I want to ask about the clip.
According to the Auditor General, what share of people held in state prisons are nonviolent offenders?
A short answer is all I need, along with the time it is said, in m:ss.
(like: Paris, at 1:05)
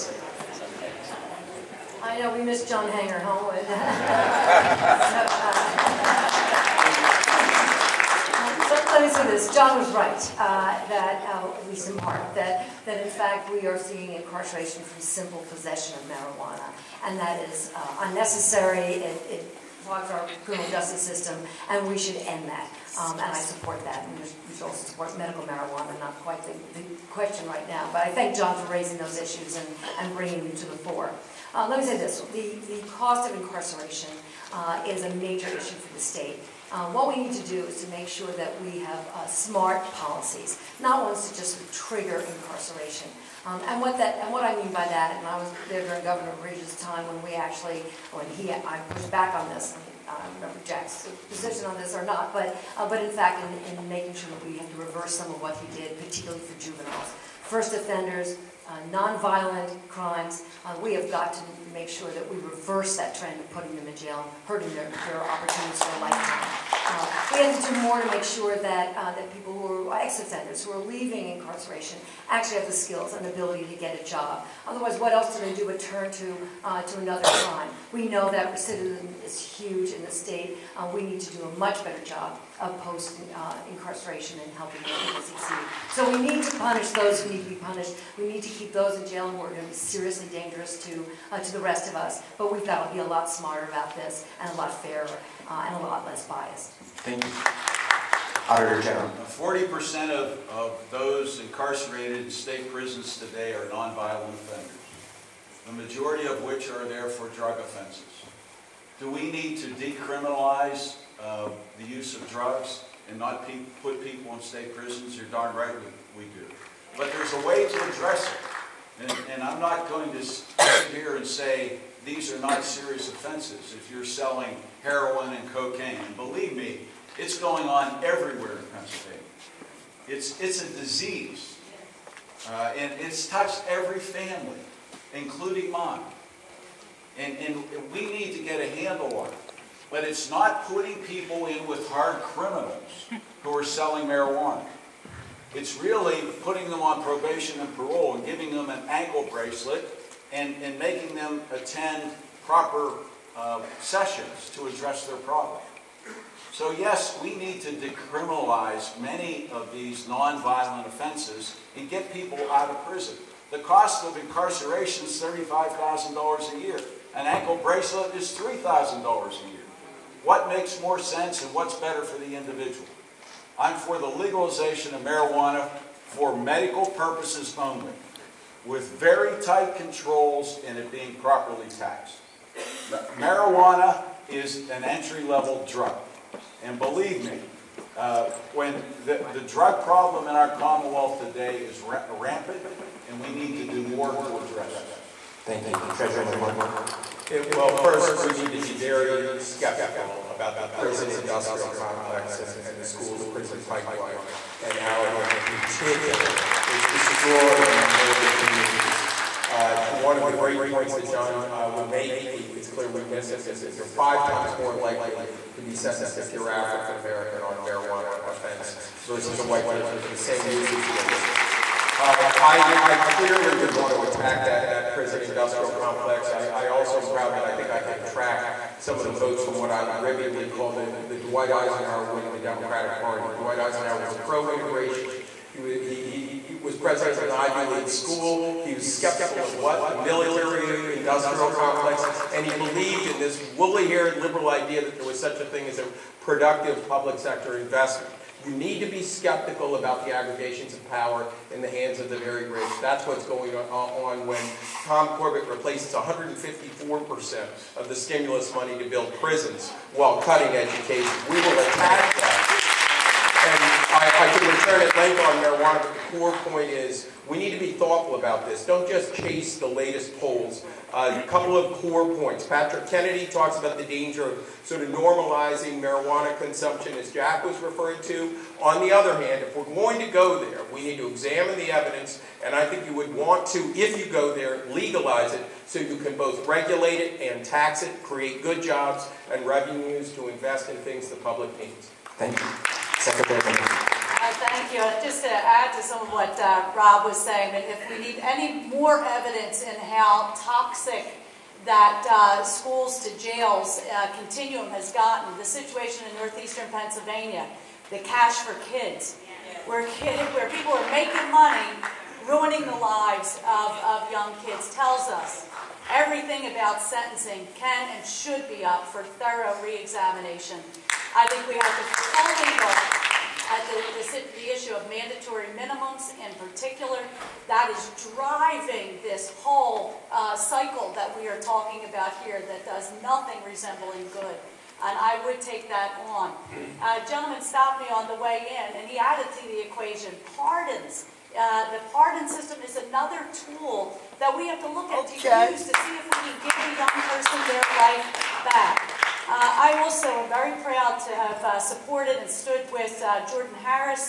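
40%, at 1:39.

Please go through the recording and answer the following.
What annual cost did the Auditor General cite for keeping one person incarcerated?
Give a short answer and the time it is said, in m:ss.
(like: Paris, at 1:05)
$35,000, at 2:45.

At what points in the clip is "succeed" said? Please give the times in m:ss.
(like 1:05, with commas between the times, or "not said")
1:25.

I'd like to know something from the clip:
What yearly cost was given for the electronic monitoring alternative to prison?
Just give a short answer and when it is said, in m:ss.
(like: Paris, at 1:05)
$3,000, at 2:48.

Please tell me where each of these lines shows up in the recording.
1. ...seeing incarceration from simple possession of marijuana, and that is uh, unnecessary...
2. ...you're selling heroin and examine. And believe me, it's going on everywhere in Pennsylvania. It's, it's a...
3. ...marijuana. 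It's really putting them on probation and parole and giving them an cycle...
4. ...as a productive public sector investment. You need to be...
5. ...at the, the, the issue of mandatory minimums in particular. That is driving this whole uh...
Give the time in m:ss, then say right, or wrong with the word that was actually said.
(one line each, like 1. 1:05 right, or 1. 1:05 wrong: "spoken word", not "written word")
1. 0:13 right
2. 2:03 wrong: "cocaine", not "examine"
3. 2:24 wrong: "ankle", not "cycle"
4. 4:05 right
5. 5:23 right.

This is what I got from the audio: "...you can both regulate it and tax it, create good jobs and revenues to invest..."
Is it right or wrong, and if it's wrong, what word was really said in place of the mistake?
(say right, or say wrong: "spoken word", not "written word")
right.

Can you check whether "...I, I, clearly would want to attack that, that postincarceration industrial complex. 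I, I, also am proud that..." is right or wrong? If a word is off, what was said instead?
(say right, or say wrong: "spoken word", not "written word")
wrong: "prison", not "postincarceration".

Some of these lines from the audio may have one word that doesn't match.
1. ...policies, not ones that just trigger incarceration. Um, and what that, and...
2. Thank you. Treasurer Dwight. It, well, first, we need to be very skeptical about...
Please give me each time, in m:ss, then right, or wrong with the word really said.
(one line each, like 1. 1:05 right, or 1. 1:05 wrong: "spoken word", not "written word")
1. 0:39 right
2. 3:15 wrong: "McCord", not "Dwight".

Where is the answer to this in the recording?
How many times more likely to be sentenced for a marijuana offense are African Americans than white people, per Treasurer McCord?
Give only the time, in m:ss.
3:33.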